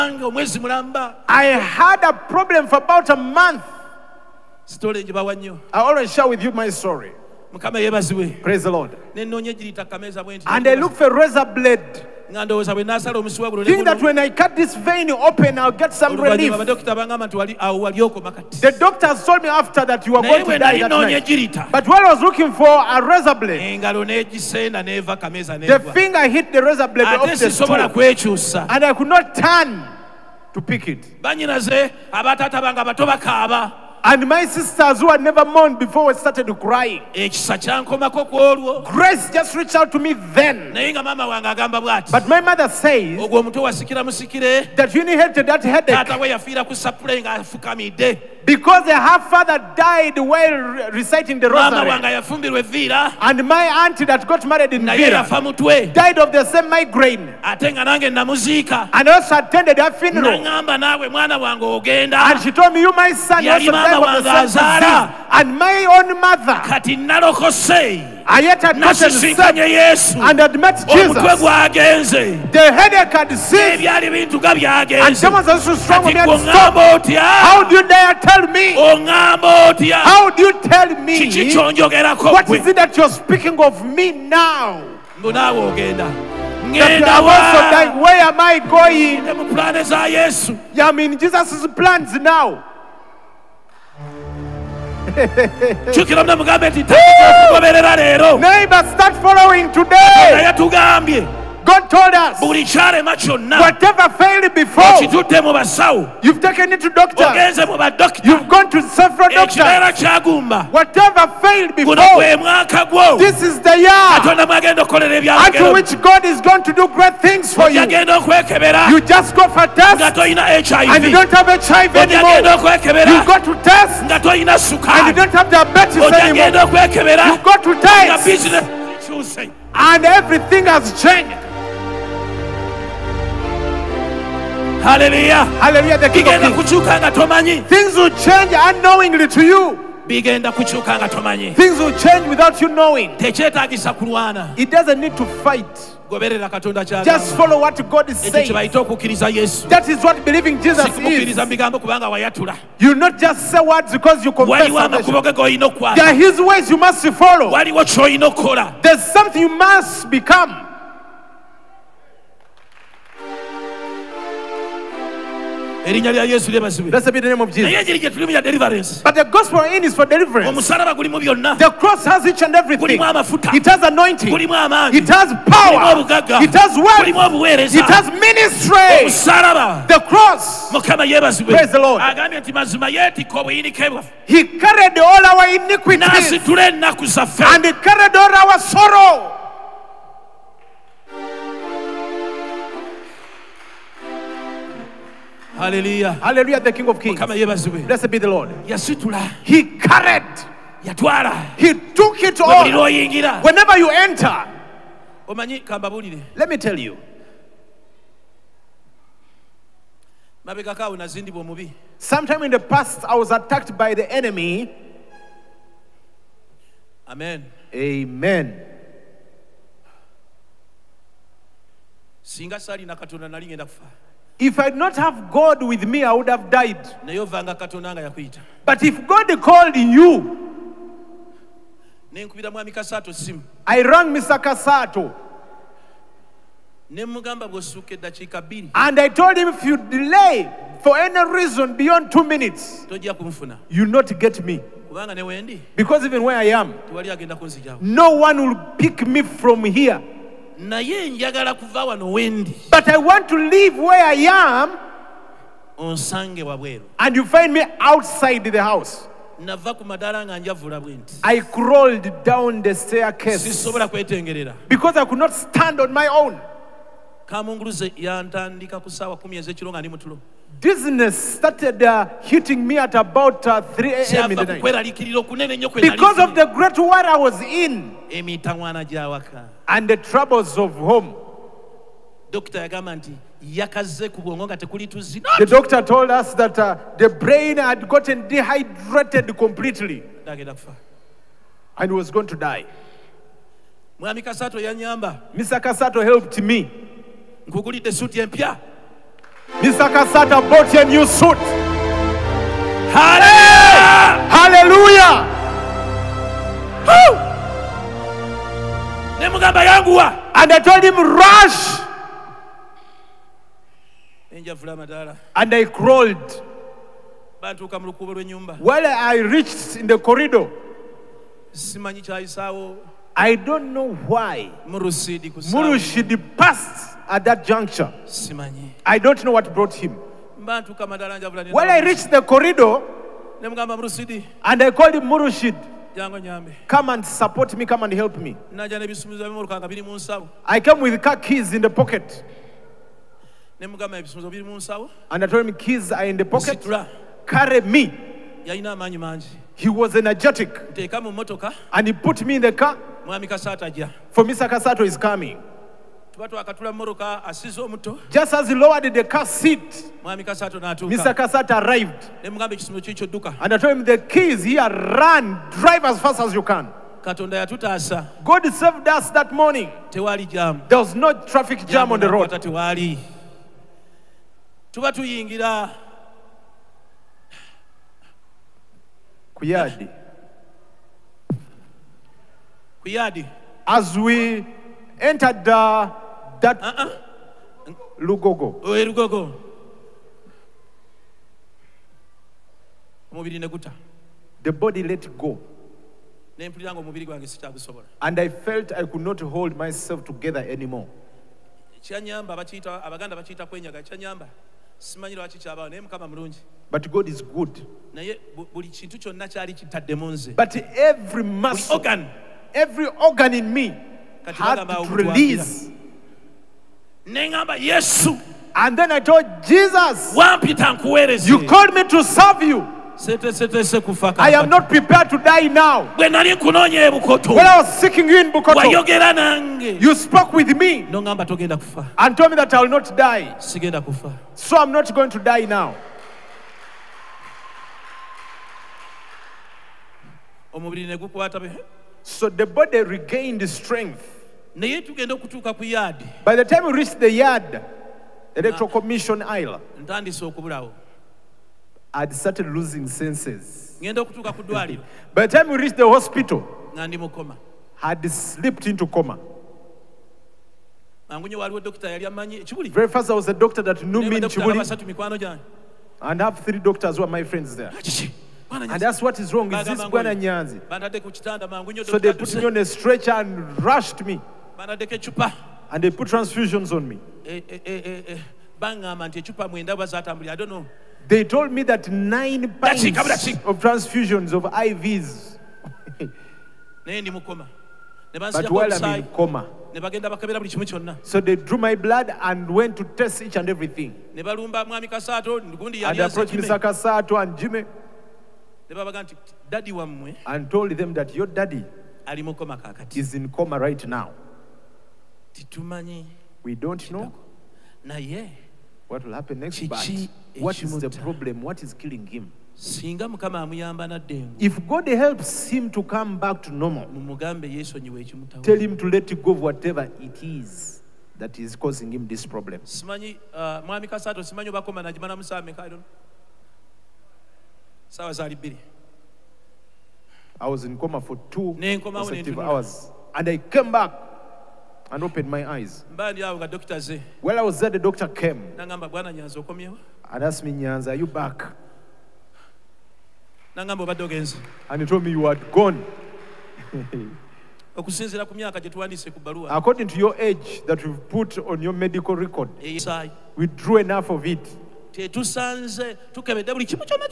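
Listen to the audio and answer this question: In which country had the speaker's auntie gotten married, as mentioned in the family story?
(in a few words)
Nigeria.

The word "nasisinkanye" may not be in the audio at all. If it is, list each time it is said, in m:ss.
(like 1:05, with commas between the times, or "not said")
1:08.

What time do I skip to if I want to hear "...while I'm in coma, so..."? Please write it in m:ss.
8:08.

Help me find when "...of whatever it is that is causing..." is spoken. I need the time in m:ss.
8:39.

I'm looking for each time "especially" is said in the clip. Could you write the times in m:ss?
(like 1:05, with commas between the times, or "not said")
not said.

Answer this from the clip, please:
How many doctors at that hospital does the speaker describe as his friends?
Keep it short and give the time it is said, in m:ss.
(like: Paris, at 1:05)
3, at 7:46.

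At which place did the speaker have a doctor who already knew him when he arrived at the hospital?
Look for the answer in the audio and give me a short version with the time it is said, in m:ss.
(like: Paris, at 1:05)
Kibuli, at 7:44.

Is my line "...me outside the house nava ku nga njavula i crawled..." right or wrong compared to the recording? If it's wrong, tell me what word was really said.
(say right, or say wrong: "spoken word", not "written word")
right.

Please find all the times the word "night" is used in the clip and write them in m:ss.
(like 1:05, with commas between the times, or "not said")
0:20, 4:34.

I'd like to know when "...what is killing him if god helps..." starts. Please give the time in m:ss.
8:31.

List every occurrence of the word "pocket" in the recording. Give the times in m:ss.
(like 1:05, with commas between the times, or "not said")
5:41, 5:46.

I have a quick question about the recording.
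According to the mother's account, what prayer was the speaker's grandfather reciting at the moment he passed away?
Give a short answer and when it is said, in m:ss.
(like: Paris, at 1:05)
the rosary, at 0:51.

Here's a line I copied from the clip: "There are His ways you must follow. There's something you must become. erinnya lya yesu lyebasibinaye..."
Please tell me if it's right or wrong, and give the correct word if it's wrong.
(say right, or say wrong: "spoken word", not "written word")
right.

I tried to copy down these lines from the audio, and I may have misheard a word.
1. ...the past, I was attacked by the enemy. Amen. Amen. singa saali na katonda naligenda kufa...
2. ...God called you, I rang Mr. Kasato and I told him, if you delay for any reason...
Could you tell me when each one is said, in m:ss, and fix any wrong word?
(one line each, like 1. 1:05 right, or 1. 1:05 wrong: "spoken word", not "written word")
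1. 3:32 right
2. 3:49 right.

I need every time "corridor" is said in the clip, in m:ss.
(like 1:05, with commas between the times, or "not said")
5:19, 5:32.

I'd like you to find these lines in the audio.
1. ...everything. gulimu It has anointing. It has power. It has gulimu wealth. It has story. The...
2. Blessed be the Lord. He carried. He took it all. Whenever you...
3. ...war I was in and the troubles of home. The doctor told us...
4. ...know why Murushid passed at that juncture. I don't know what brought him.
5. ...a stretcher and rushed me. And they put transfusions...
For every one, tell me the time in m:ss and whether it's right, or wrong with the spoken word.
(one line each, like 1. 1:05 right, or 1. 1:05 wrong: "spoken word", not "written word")
1. 2:52 wrong: "ministry", not "story"
2. 3:17 right
3. 4:36 right
4. 5:23 right
5. 7:52 right.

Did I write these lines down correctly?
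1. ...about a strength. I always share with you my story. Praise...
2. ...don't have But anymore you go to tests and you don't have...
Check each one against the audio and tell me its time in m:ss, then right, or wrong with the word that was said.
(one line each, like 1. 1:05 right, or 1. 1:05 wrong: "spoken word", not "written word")
1. 0:02 wrong: "month", not "strength"
2. 2:01 wrong: "HIV", not "But".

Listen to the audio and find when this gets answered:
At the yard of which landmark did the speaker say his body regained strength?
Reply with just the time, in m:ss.
7:28.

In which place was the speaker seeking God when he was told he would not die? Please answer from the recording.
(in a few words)
Bukoto.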